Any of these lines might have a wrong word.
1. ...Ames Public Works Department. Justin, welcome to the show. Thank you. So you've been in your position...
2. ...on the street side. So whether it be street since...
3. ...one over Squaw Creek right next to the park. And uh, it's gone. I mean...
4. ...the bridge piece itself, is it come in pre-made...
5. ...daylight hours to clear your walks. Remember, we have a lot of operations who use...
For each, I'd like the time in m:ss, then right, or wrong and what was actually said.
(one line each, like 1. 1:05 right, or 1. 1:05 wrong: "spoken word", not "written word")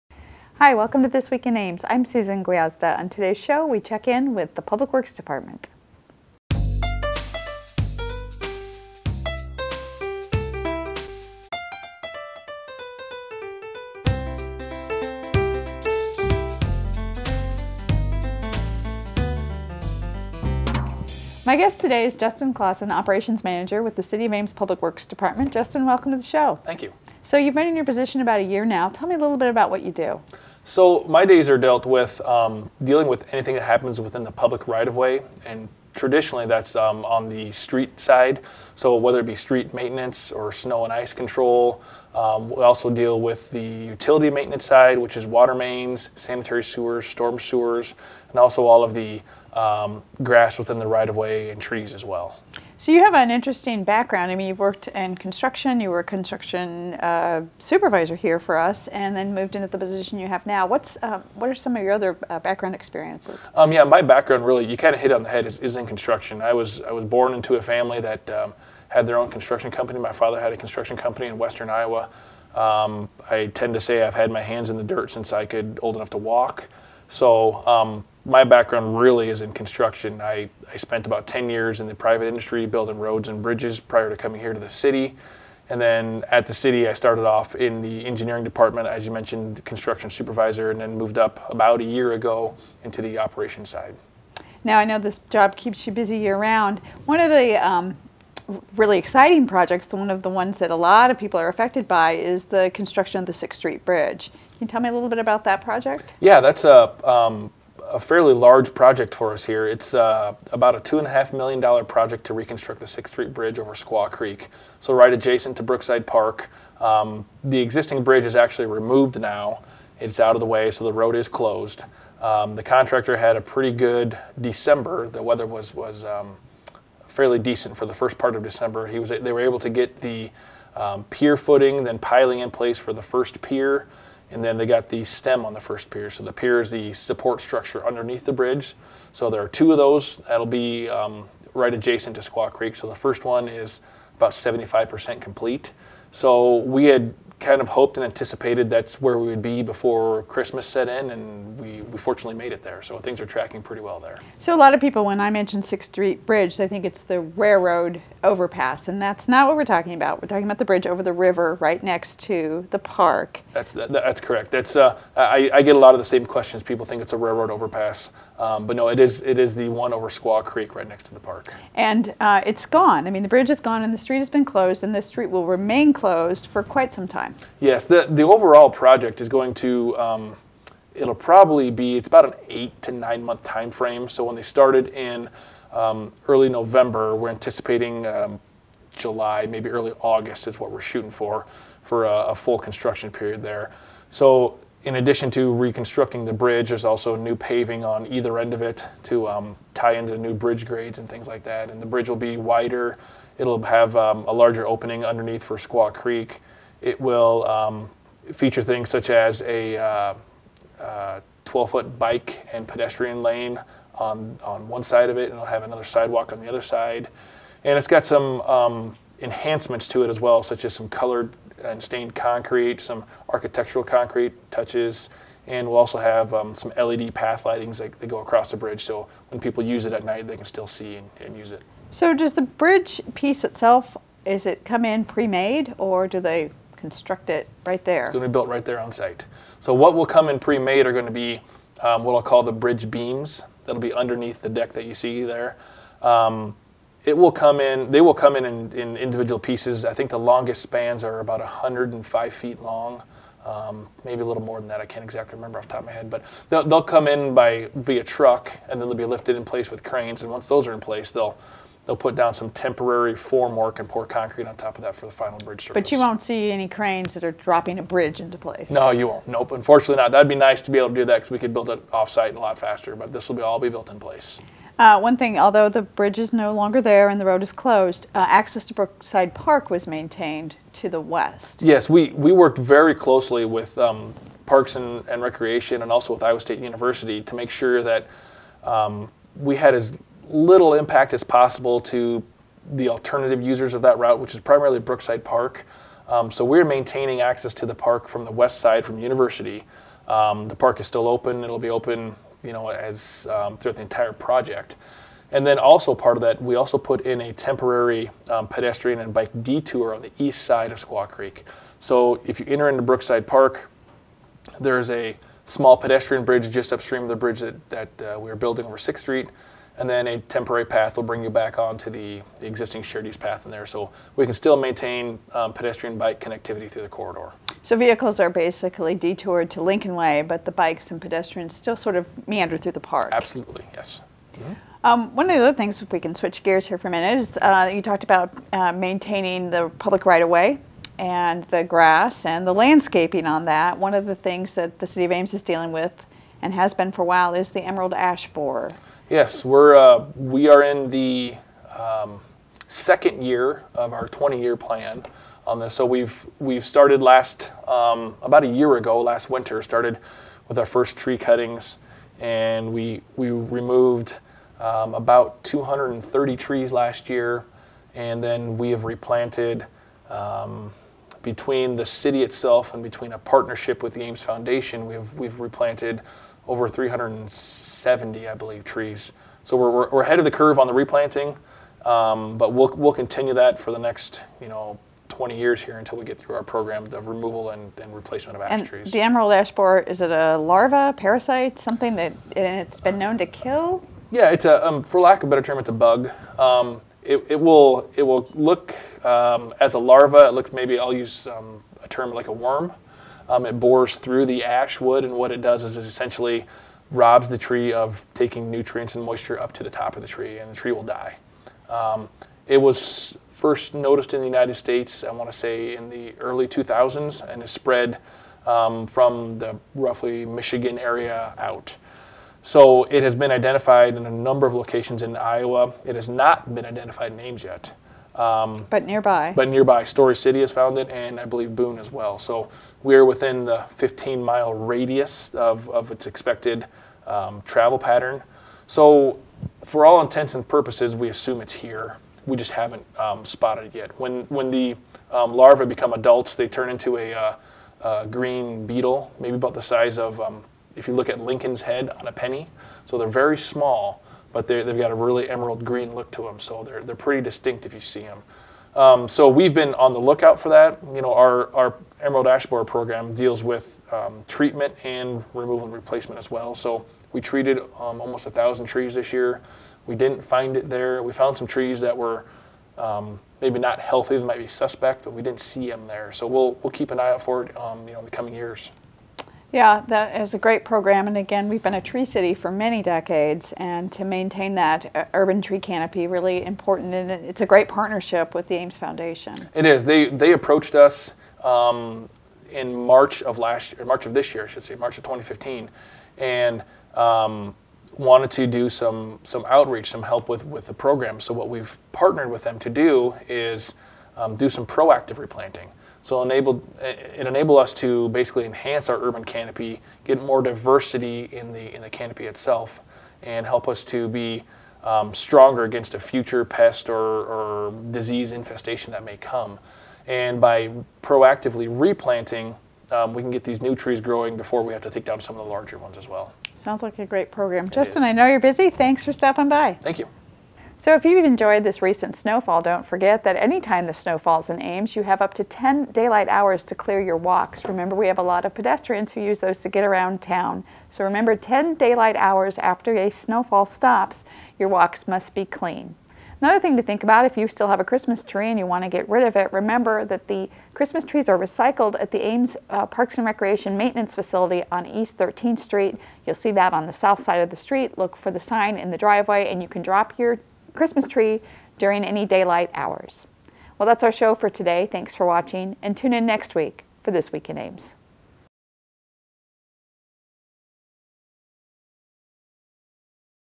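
1. 0:24 right
2. 0:37 wrong: "maintenance", not "since"
3. 2:49 right
4. 3:52 right
5. 8:55 wrong: "pedestrians", not "operations".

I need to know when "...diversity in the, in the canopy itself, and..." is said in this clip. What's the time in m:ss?
8:30.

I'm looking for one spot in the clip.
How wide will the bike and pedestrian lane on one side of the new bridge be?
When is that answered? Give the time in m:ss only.
3:31.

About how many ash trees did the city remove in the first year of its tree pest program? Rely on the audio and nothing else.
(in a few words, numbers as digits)
230.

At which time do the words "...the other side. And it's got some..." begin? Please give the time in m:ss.
3:36.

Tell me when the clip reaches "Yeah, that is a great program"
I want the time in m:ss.
7:59.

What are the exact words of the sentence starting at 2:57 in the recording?
Yes, the the overall project is going to.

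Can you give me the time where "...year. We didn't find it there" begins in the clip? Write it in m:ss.
7:49.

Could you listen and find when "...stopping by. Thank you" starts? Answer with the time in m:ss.
8:49.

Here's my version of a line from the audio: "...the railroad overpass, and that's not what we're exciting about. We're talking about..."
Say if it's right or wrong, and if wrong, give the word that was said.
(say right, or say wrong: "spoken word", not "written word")
wrong: "talking", not "exciting".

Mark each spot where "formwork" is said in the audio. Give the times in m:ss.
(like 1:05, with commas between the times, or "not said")
4:23.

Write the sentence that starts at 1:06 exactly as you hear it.
I was I was born into a family that um, had their own construction company.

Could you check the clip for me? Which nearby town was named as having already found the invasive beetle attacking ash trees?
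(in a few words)
Story City.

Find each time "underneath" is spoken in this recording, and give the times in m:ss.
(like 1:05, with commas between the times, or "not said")
2:17, 3:25, 4:03.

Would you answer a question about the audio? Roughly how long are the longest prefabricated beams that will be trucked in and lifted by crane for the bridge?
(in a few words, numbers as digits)
105 feet.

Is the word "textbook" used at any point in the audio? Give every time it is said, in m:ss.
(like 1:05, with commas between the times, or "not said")
not said.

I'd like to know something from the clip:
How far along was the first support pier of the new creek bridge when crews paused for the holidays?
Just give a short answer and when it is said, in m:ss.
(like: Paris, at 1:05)
75%, at 2:24.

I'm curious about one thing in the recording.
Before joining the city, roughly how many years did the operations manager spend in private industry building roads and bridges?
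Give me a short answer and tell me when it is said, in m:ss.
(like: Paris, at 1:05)
10 years, at 1:21.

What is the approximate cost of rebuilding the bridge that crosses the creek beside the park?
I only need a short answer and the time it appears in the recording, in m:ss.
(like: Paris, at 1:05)
$2.5 million, at 1:50.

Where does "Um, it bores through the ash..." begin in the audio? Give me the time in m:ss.
6:43.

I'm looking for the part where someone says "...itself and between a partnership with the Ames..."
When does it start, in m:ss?
6:12.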